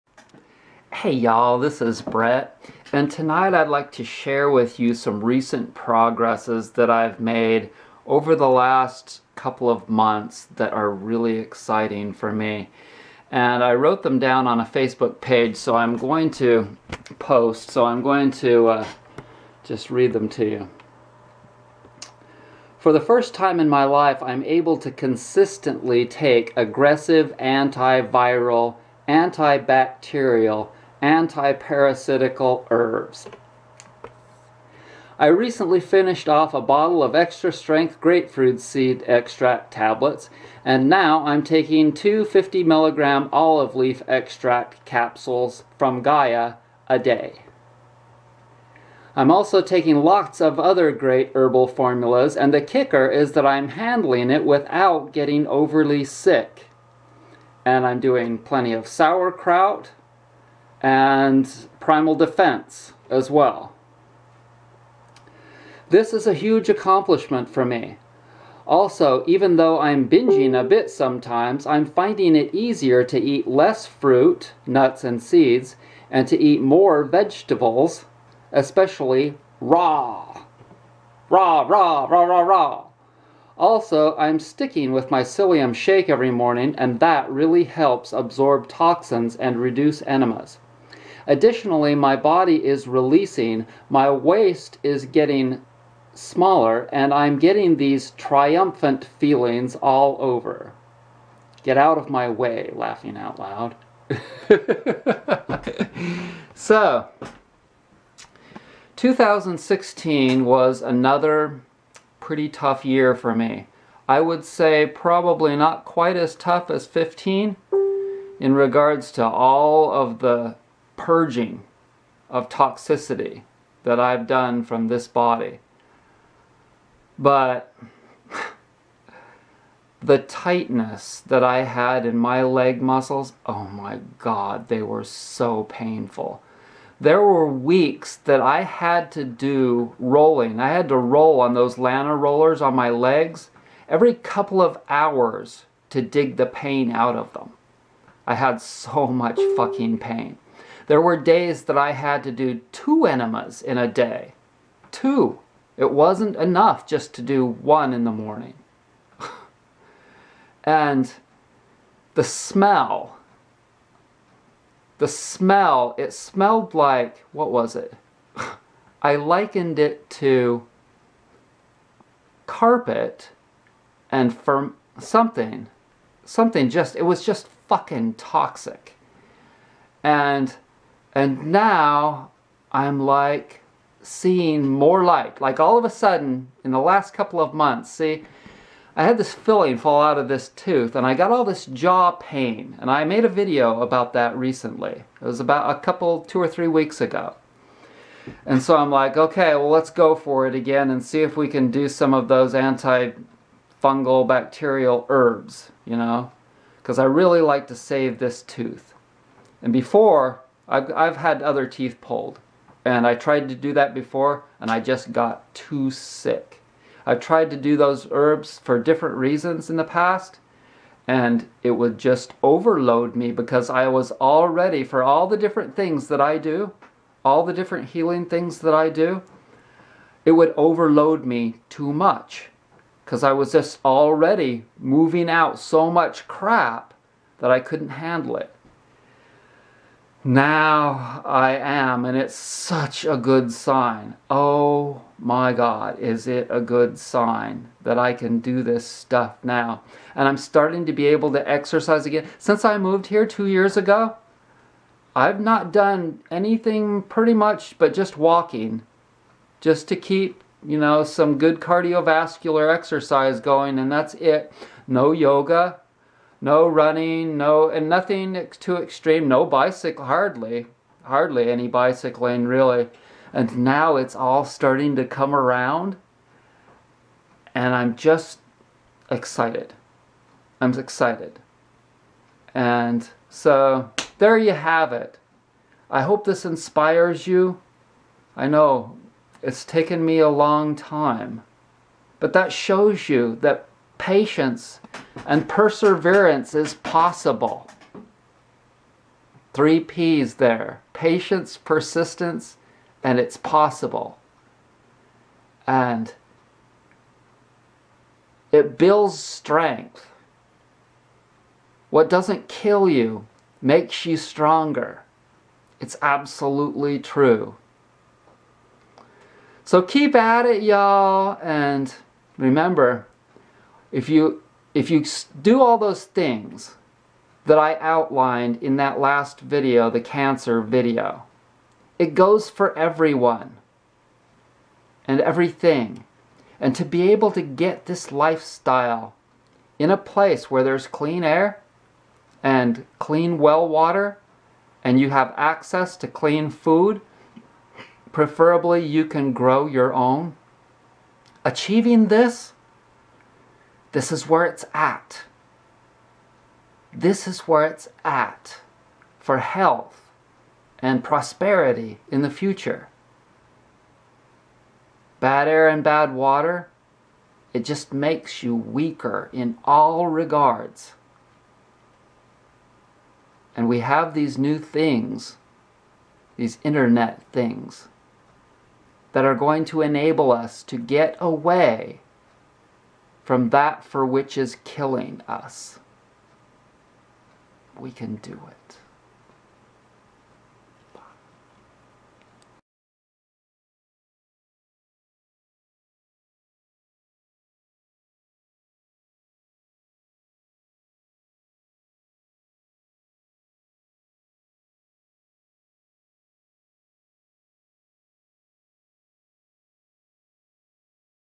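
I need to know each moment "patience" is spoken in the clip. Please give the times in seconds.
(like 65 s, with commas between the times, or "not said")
294 s, 300 s.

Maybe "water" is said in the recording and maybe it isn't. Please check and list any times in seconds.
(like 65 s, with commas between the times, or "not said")
343 s, 366 s.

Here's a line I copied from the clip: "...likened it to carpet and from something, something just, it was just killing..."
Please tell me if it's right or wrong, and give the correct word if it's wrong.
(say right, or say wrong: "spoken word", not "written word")
wrong: "fucking", not "killing".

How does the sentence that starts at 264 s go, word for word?
No yoga, no running, no, and nothing too extreme, no bicycle, hardly, hardly any bicycling really.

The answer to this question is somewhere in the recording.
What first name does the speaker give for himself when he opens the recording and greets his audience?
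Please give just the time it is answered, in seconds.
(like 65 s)
1 s.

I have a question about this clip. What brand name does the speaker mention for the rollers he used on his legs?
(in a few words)
Lana.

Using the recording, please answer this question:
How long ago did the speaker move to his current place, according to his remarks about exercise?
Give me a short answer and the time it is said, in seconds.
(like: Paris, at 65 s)
2 years, at 253 s.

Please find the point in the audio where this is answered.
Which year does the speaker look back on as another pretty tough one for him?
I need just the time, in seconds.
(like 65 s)
108 s.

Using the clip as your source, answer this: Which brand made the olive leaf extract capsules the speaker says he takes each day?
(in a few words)
Gaia.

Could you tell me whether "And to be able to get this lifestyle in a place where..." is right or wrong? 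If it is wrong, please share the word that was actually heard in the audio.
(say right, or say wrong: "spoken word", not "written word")
right.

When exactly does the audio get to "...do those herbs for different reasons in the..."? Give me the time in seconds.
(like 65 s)
217 s.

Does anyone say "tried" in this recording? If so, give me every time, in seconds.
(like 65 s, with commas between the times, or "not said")
213 s, 217 s.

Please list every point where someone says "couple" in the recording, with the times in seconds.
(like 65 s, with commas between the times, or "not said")
9 s, 144 s, 187 s, 195 s.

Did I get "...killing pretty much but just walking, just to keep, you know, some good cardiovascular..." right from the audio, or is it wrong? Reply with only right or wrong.
wrong.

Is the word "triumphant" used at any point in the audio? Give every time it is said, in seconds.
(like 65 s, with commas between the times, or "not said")
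98 s.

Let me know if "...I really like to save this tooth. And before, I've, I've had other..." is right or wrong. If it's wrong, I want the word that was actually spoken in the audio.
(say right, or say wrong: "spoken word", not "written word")
right.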